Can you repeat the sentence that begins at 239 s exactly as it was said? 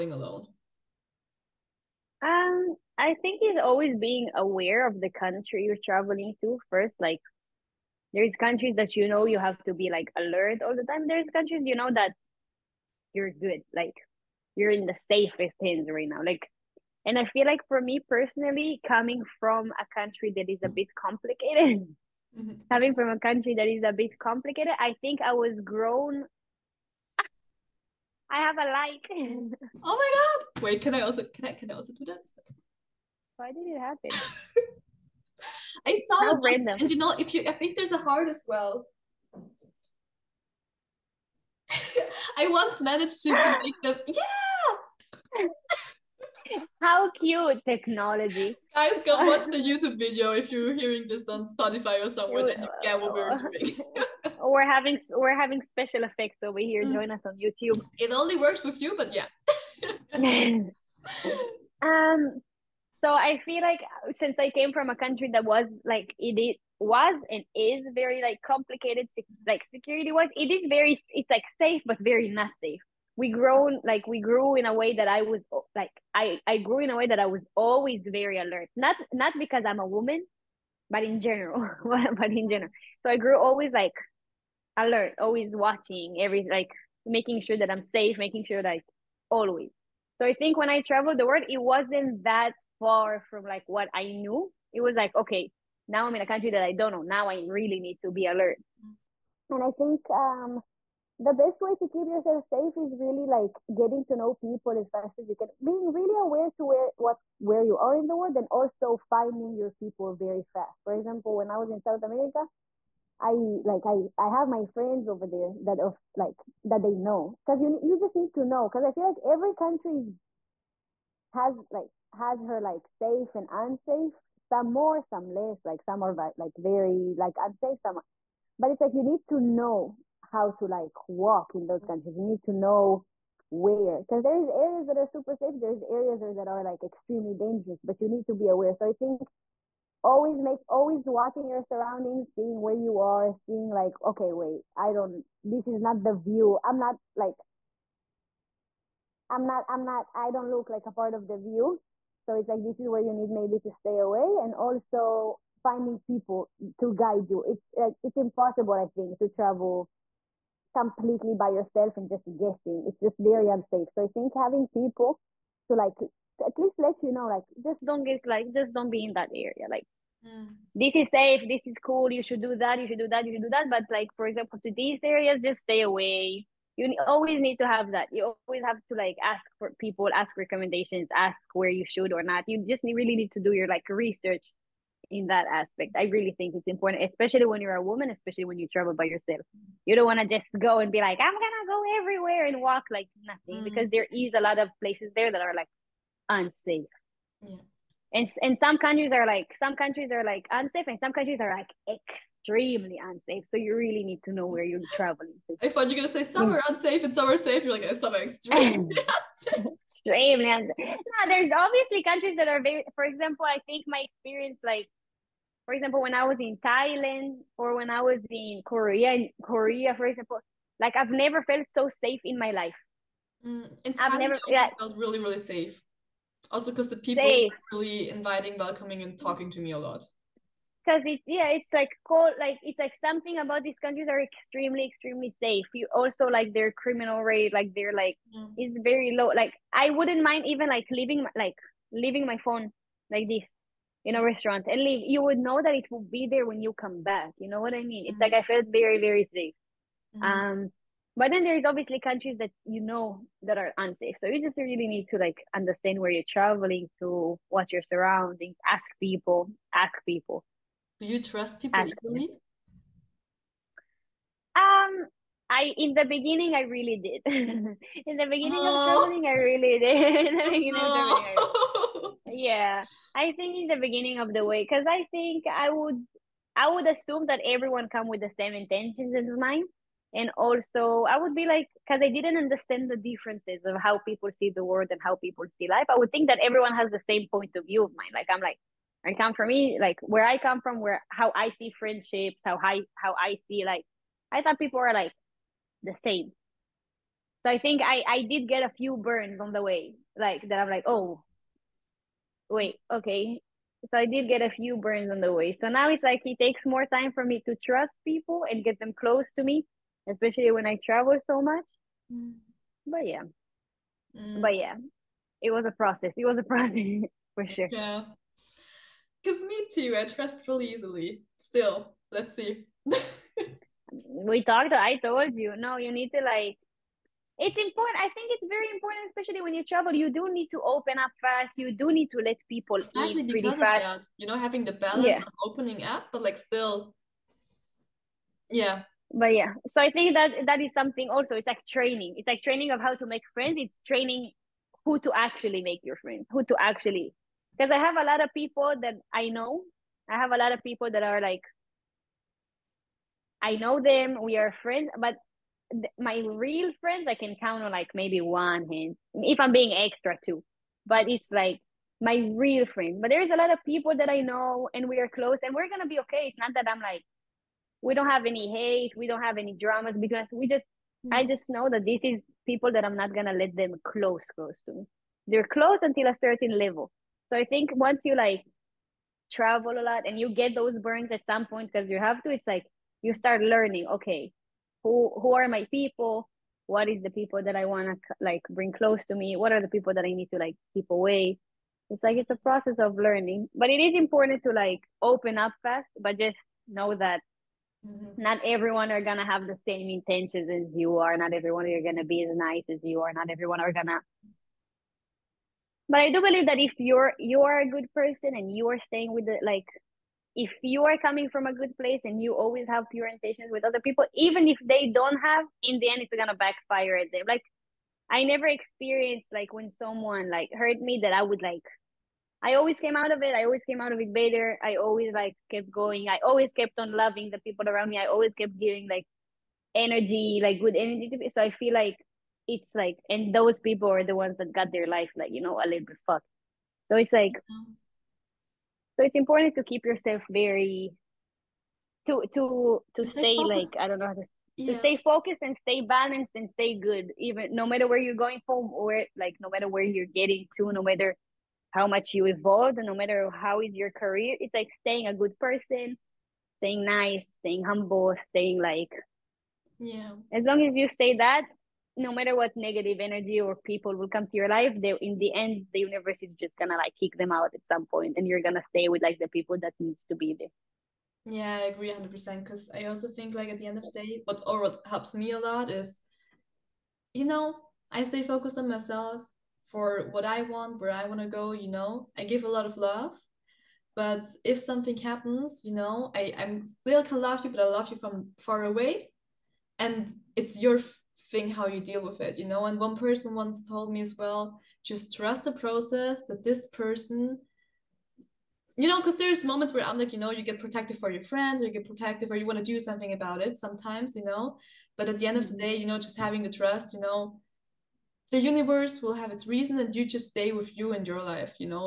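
Like I wouldn't mind even like leaving, like leaving my phone like this in a restaurant and leave.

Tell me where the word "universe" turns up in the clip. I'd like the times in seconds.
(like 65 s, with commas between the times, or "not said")
465 s, 508 s.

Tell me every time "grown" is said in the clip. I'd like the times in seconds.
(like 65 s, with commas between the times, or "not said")
25 s, 73 s.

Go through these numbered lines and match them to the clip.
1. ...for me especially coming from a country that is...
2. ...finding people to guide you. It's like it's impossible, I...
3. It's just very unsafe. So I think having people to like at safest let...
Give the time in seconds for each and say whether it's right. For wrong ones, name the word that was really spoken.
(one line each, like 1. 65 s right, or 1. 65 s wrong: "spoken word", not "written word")
1. 17 s wrong: "personally", not "especially"
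2. 155 s right
3. 162 s wrong: "least", not "safest".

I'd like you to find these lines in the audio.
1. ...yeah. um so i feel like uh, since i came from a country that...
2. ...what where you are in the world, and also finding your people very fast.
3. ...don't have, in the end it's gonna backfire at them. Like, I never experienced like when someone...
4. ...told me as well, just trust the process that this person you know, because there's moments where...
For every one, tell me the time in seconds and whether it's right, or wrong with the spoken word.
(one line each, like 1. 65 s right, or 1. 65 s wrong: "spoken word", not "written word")
1. 59 s right
2. 106 s right
3. 414 s right
4. 493 s right.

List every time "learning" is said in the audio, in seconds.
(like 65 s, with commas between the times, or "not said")
383 s, 392 s.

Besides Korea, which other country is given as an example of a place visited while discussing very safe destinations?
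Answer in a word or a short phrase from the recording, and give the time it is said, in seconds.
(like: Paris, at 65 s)
Thailand, at 216 s.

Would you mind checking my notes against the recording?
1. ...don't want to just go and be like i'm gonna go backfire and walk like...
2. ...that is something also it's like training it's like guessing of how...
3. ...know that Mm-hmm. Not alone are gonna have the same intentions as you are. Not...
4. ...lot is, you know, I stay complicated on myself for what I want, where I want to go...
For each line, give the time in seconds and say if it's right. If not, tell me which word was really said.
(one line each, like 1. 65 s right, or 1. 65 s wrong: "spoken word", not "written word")
1. 189 s wrong: "everywhere", not "backfire"
2. 340 s wrong: "training", not "guessing"
3. 396 s wrong: "everyone", not "alone"
4. 475 s wrong: "focused", not "complicated".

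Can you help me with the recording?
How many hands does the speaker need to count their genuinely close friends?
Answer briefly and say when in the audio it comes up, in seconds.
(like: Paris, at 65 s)
1, at 358 s.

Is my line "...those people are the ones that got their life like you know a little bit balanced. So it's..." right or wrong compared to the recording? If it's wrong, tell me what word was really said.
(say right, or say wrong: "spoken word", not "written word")
wrong: "fucked", not "balanced".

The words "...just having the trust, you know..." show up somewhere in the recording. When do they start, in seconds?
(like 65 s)
505 s.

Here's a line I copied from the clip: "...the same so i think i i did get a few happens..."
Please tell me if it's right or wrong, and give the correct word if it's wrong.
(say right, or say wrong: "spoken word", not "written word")
wrong: "burns", not "happens".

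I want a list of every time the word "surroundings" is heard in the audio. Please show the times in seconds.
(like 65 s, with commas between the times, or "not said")
141 s, 257 s.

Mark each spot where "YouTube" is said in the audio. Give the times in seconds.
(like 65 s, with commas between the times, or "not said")
49 s, 57 s.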